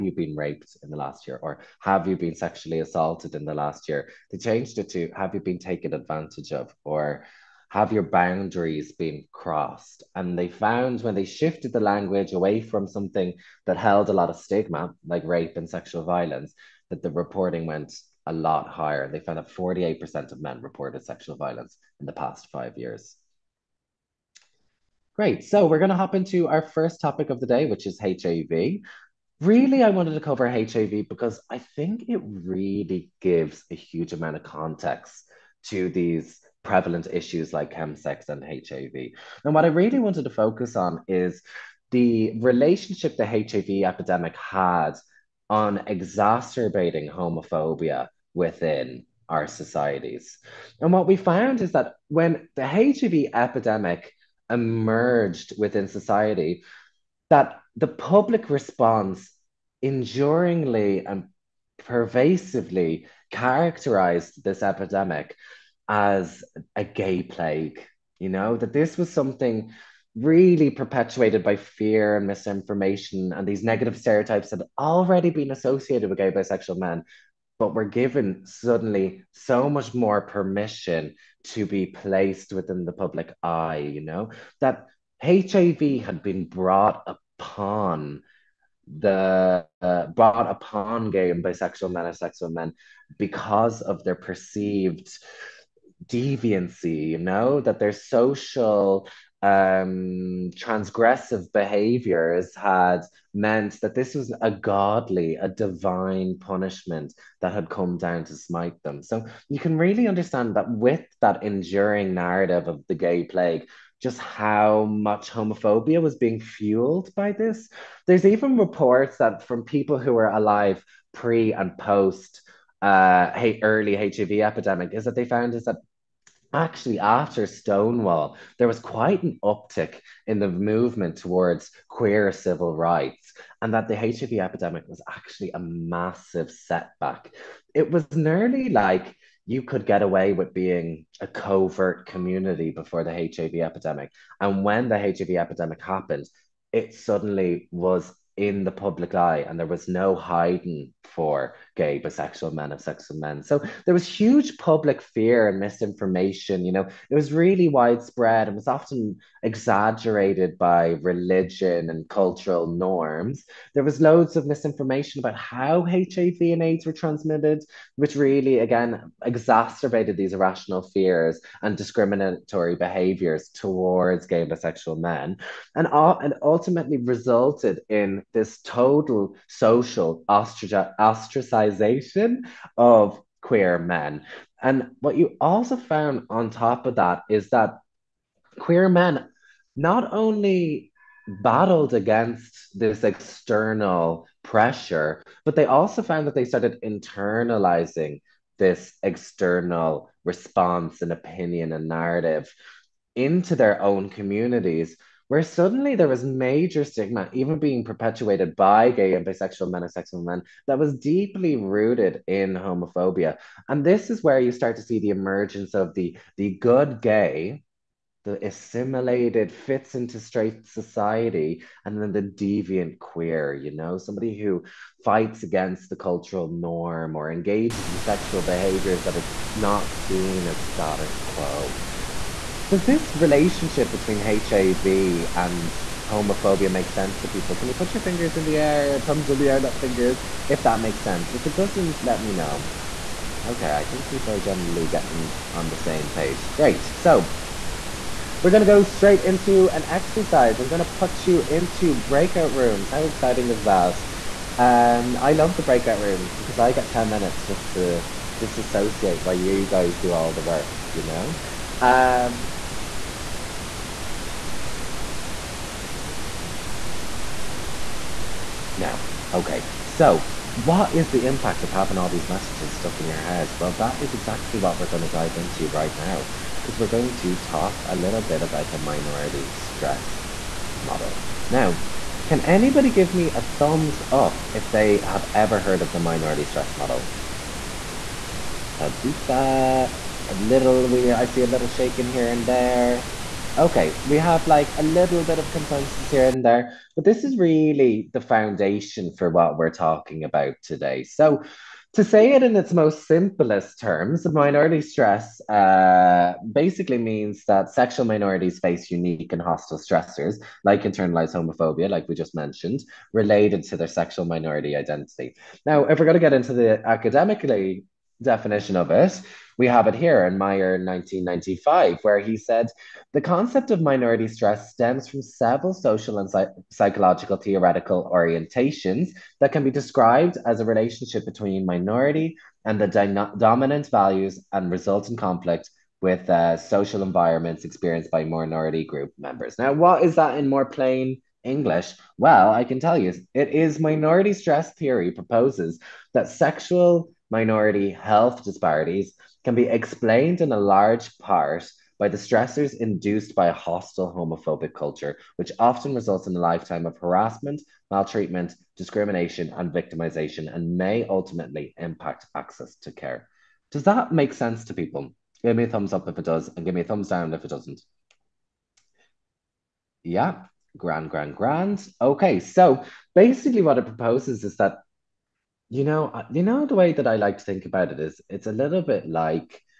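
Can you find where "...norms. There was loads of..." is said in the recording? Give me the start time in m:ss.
2:42.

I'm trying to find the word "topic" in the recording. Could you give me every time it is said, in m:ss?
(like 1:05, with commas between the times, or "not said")
0:26.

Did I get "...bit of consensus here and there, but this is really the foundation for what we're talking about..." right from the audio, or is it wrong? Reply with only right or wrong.
right.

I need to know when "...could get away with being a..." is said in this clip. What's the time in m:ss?
2:19.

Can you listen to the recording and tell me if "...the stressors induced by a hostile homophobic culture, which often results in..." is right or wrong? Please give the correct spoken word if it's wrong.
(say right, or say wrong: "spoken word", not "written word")
right.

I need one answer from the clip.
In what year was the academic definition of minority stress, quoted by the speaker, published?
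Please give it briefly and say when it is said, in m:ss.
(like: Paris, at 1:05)
1995, at 5:20.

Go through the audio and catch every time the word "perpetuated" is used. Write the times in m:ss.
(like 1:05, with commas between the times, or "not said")
1:10, 3:27.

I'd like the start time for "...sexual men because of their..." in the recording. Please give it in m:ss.
1:32.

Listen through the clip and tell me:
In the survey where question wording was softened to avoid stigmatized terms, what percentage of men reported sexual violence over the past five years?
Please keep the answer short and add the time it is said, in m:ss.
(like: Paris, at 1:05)
48%, at 0:19.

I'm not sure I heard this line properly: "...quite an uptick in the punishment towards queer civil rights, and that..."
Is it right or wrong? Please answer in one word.
wrong.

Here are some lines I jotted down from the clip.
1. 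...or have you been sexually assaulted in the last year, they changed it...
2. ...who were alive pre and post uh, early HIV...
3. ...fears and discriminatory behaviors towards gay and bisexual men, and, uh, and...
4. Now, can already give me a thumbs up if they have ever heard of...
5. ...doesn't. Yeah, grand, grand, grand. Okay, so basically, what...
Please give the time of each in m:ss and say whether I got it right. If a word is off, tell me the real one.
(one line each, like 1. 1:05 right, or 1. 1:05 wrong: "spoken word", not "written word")
1. 0:01 right
2. 1:59 right
3. 2:50 right
4. 4:41 wrong: "anybody", not "already"
5. 6:07 right.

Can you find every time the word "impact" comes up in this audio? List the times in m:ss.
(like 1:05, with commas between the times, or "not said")
4:31, 6:01.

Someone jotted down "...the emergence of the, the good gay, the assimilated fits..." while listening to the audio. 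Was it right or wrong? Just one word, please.
right.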